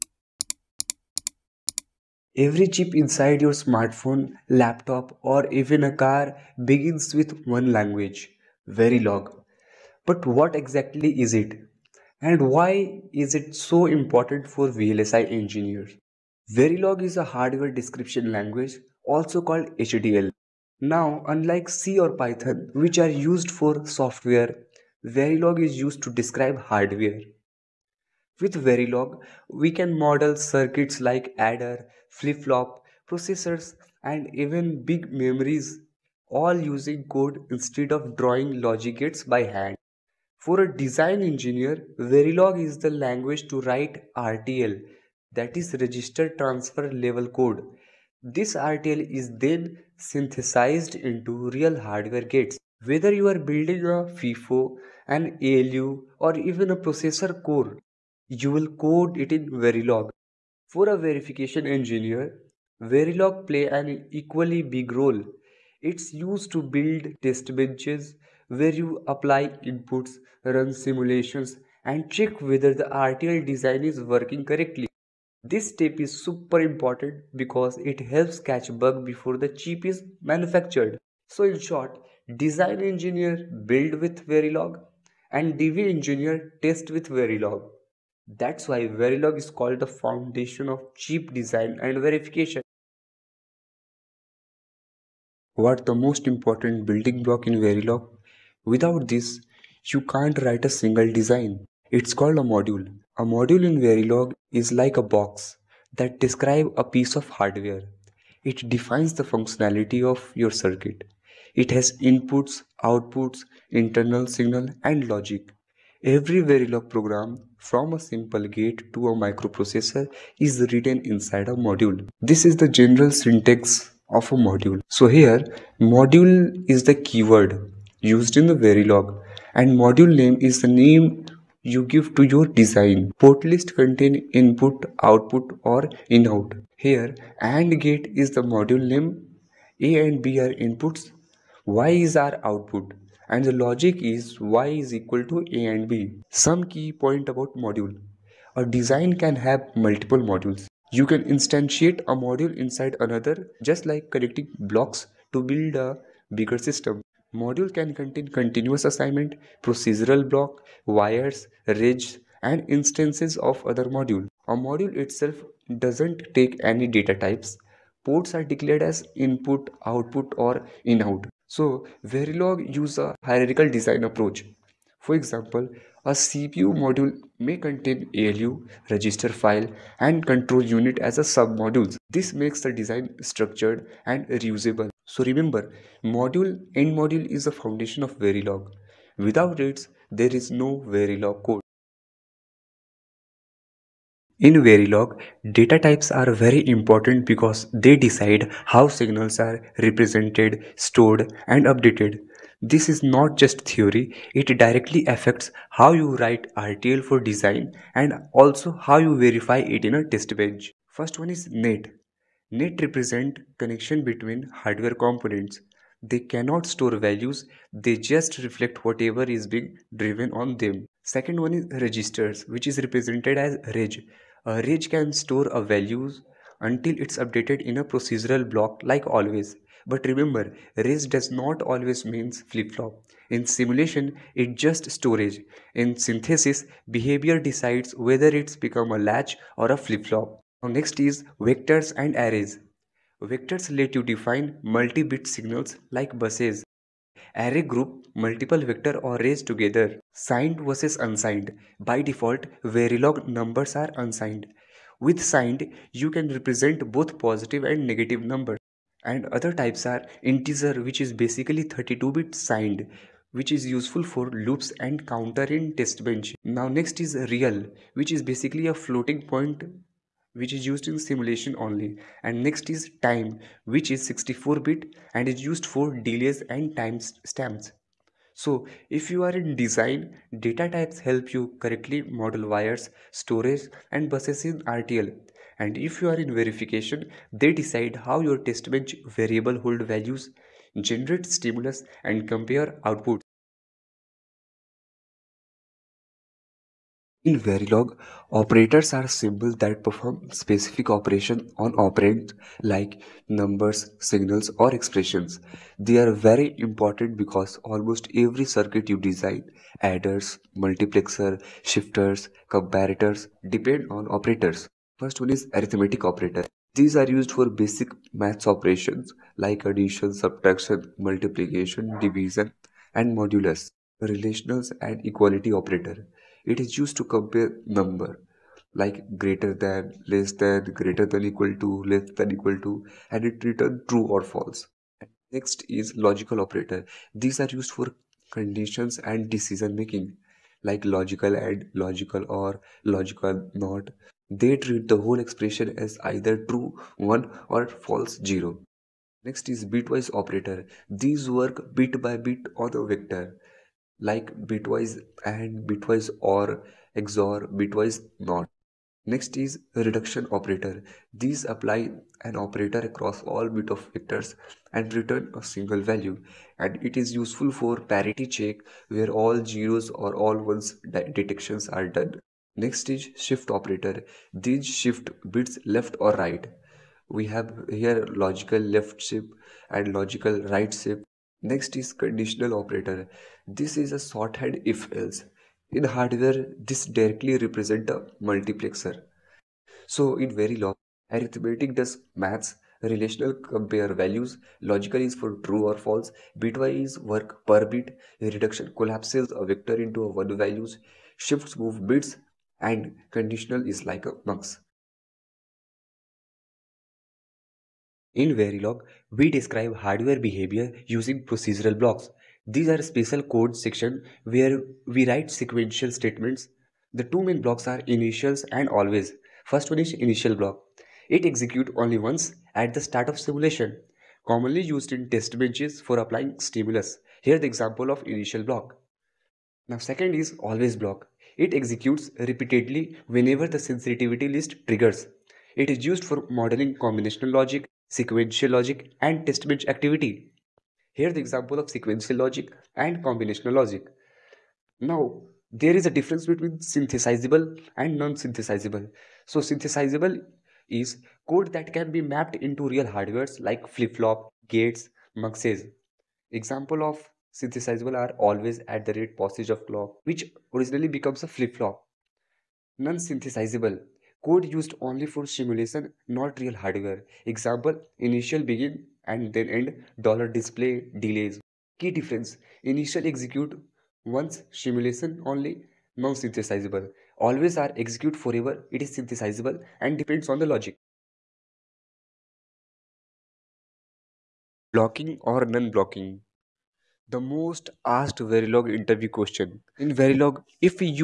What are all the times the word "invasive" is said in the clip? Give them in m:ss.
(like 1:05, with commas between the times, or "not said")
not said.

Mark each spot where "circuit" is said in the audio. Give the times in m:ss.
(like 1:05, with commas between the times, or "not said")
0:30, 1:50, 5:08.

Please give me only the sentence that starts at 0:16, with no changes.
Verilog is a hardware description language, also called HDL.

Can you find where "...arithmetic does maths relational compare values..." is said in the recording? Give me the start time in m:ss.
6:31.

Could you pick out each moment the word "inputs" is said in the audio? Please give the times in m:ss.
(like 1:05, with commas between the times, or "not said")
1:09, 1:51, 2:14, 2:20, 2:49.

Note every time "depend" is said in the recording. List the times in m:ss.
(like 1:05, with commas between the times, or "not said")
5:13, 7:59.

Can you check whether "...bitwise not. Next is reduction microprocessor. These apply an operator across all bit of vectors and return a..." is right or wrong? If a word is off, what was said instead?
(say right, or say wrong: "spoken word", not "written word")
wrong: "operator", not "microprocessor".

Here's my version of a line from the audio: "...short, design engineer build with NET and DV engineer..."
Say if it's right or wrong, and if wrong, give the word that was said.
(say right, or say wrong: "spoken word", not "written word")
wrong: "Verilog", not "NET".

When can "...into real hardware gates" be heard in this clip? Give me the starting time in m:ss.
0:50.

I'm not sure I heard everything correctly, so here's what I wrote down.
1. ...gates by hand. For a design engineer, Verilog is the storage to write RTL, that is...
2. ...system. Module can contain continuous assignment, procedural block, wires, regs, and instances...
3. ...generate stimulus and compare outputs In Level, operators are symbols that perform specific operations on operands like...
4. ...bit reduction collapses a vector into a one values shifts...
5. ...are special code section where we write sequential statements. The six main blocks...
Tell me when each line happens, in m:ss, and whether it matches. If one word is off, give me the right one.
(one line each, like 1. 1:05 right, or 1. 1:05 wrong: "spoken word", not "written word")
1. 0:38 wrong: "language", not "storage"
2. 2:36 right
3. 4:50 wrong: "Verilog", not "Level"
4. 6:37 right
5. 6:52 wrong: "two", not "six".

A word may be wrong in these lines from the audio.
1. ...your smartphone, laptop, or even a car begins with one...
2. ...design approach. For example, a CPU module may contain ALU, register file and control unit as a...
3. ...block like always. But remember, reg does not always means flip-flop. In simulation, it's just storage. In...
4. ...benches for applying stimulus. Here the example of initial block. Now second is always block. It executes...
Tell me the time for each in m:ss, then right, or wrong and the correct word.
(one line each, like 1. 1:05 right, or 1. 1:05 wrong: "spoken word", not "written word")
1. 0:03 right
2. 2:53 right
3. 3:48 right
4. 7:05 right.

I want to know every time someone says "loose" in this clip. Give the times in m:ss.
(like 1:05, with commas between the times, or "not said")
not said.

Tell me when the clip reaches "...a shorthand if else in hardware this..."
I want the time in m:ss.
6:23.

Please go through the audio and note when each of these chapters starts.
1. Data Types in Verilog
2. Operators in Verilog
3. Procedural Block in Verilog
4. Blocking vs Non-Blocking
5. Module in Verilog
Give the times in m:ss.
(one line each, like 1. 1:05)
1. 3:10
2. 4:52
3. 6:43
4. 7:59
5. 1:31.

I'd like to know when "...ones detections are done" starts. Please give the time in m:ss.
6:10.